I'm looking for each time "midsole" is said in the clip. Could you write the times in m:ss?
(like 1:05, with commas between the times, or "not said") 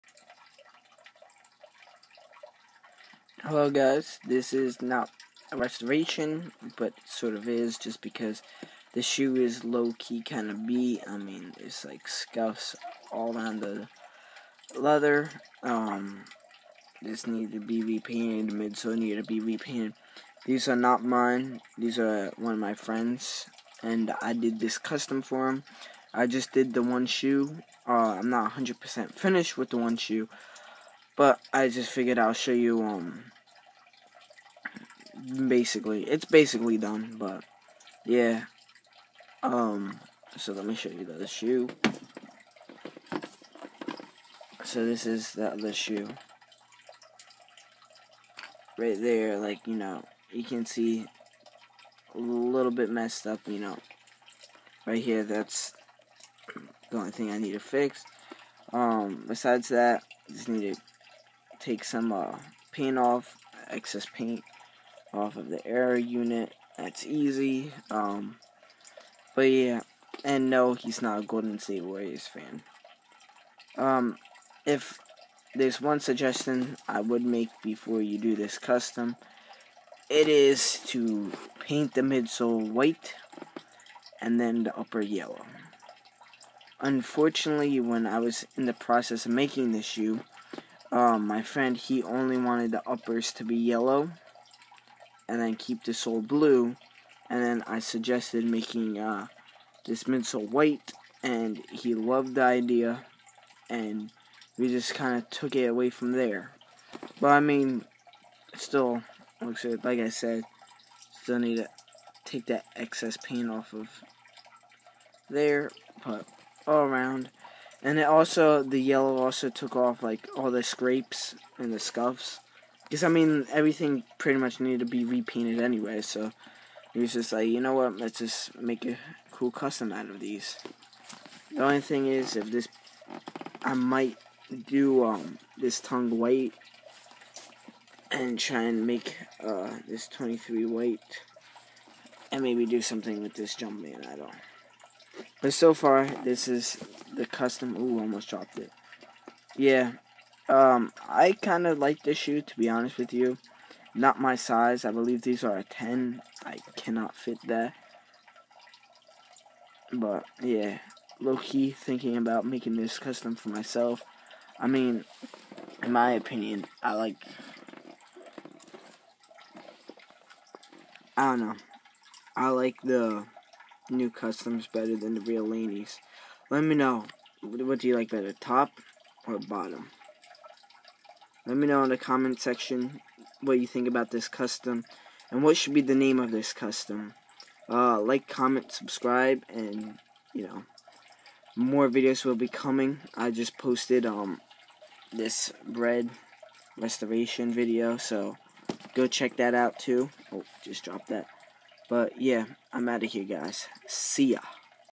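0:18, 1:22, 1:40.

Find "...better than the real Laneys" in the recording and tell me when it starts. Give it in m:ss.
2:54.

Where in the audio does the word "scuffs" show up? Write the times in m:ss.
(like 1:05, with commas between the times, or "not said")
0:12, 2:01.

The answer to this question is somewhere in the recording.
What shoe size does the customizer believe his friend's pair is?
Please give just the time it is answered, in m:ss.
2:35.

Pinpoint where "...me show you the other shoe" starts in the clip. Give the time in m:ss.
0:40.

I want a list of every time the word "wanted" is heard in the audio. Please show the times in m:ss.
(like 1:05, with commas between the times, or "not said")
1:32.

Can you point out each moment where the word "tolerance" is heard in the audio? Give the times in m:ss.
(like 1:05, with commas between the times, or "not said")
not said.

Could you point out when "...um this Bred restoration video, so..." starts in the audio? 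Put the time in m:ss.
3:14.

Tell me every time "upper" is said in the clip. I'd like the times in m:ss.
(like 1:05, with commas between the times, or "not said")
1:24, 1:32.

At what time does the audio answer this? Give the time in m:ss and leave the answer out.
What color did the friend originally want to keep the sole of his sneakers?
1:35.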